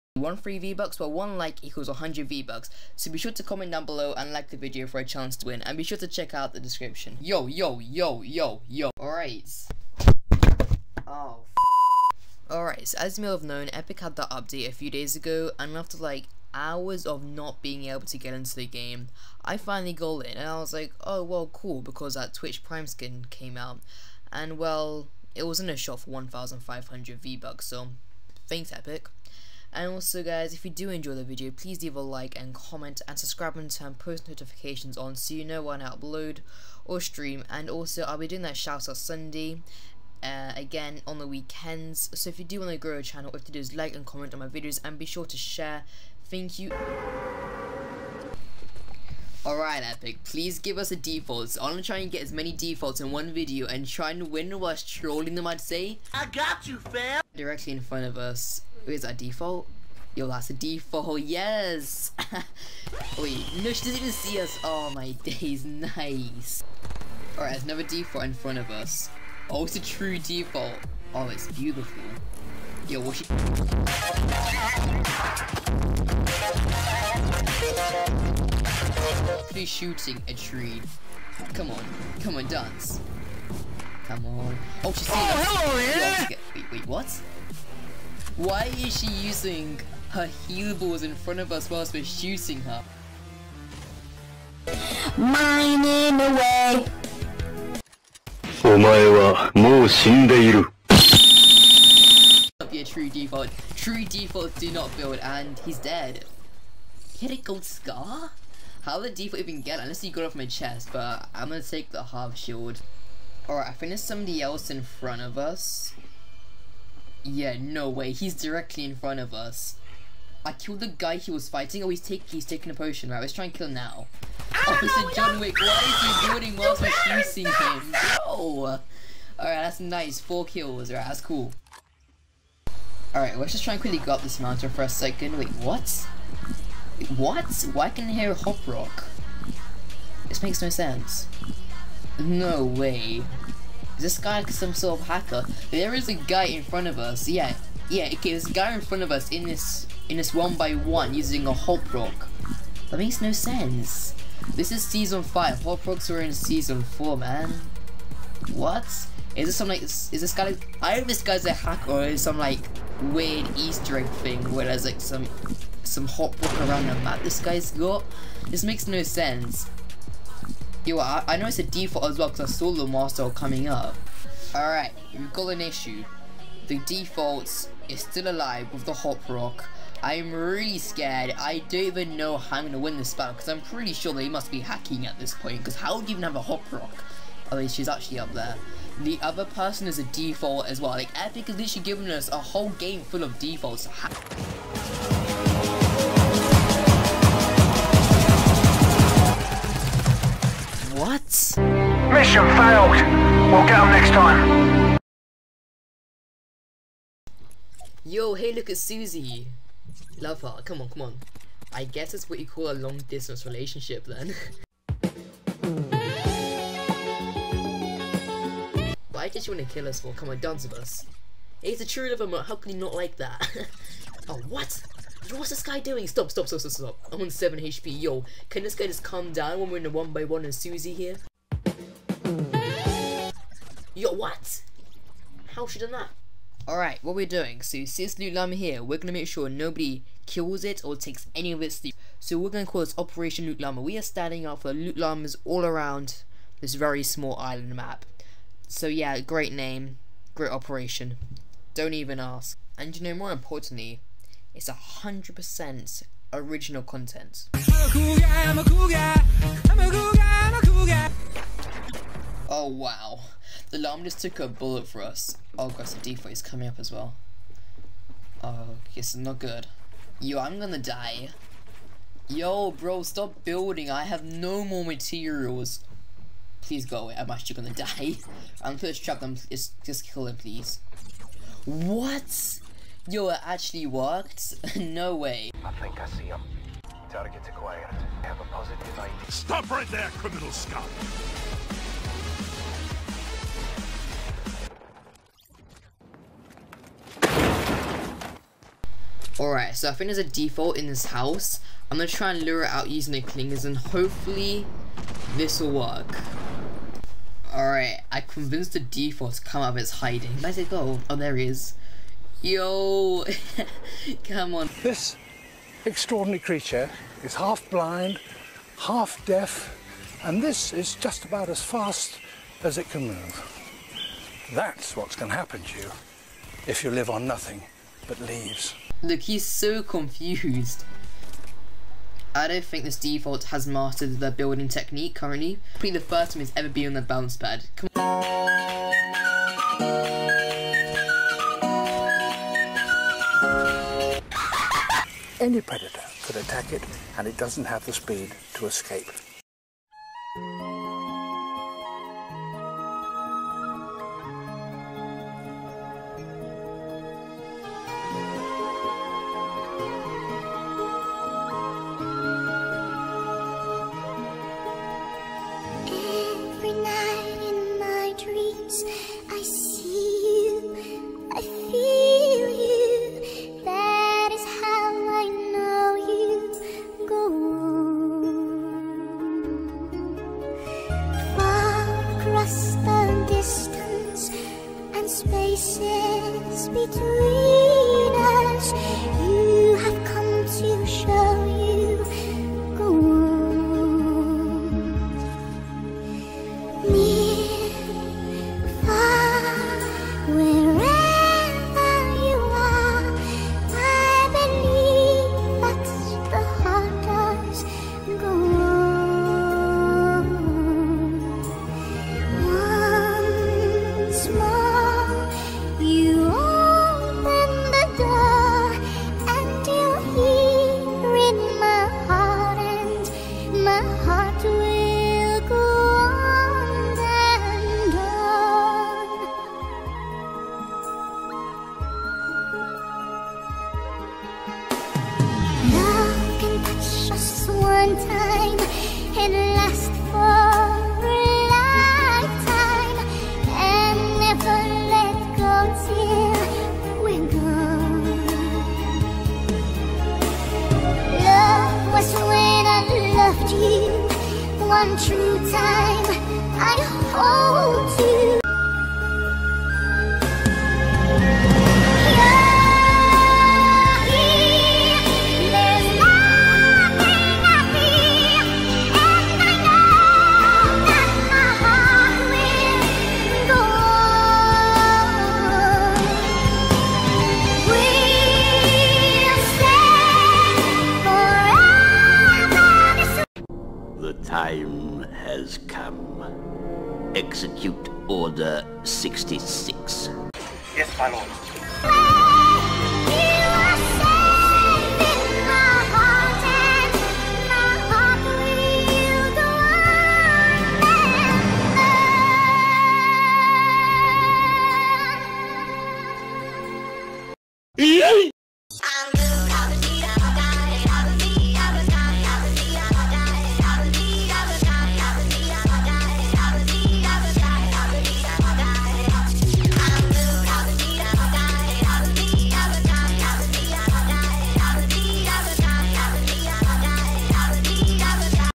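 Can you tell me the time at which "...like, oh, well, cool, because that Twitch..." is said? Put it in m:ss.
0:20.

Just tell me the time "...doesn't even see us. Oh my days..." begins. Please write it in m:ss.
1:03.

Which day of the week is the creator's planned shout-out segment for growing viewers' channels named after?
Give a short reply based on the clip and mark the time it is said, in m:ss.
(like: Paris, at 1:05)
Sunday, at 0:38.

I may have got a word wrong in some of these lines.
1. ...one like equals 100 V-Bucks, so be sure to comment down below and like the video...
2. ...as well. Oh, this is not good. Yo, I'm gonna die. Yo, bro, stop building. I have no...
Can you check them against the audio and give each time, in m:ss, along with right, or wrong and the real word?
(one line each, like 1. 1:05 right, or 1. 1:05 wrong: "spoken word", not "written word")
1. 0:01 right
2. 4:26 right.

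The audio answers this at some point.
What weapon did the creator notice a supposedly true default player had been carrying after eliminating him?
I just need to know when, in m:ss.
1:47.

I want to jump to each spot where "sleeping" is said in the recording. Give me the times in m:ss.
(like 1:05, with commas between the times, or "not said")
not said.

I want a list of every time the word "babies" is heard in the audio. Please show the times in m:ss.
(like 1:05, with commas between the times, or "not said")
not said.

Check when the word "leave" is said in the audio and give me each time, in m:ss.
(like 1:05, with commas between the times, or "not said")
0:31, 5:28.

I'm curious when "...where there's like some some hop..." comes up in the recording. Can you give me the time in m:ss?
2:44.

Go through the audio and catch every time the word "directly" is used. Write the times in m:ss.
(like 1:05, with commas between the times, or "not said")
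0:57, 1:58.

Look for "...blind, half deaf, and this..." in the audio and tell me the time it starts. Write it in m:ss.
5:17.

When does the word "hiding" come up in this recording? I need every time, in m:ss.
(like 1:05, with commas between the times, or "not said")
5:09.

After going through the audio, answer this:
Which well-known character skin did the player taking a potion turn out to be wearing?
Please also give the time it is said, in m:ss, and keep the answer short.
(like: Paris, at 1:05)
John Wick, at 2:05.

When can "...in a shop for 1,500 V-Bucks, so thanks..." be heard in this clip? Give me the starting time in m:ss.
0:25.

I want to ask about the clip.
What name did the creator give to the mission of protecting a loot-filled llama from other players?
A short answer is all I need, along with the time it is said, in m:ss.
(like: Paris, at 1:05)
Operation Loot Llama, at 4:02.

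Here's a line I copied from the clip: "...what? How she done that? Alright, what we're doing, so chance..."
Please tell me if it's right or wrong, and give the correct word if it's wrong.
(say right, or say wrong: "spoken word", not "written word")
wrong: "since", not "chance".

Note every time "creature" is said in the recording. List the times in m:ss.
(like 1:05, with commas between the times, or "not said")
5:16.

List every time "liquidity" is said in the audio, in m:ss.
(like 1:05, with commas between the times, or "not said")
not said.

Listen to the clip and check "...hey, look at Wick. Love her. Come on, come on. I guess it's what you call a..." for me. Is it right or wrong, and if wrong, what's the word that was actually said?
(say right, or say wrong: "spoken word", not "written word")
wrong: "Susie", not "Wick".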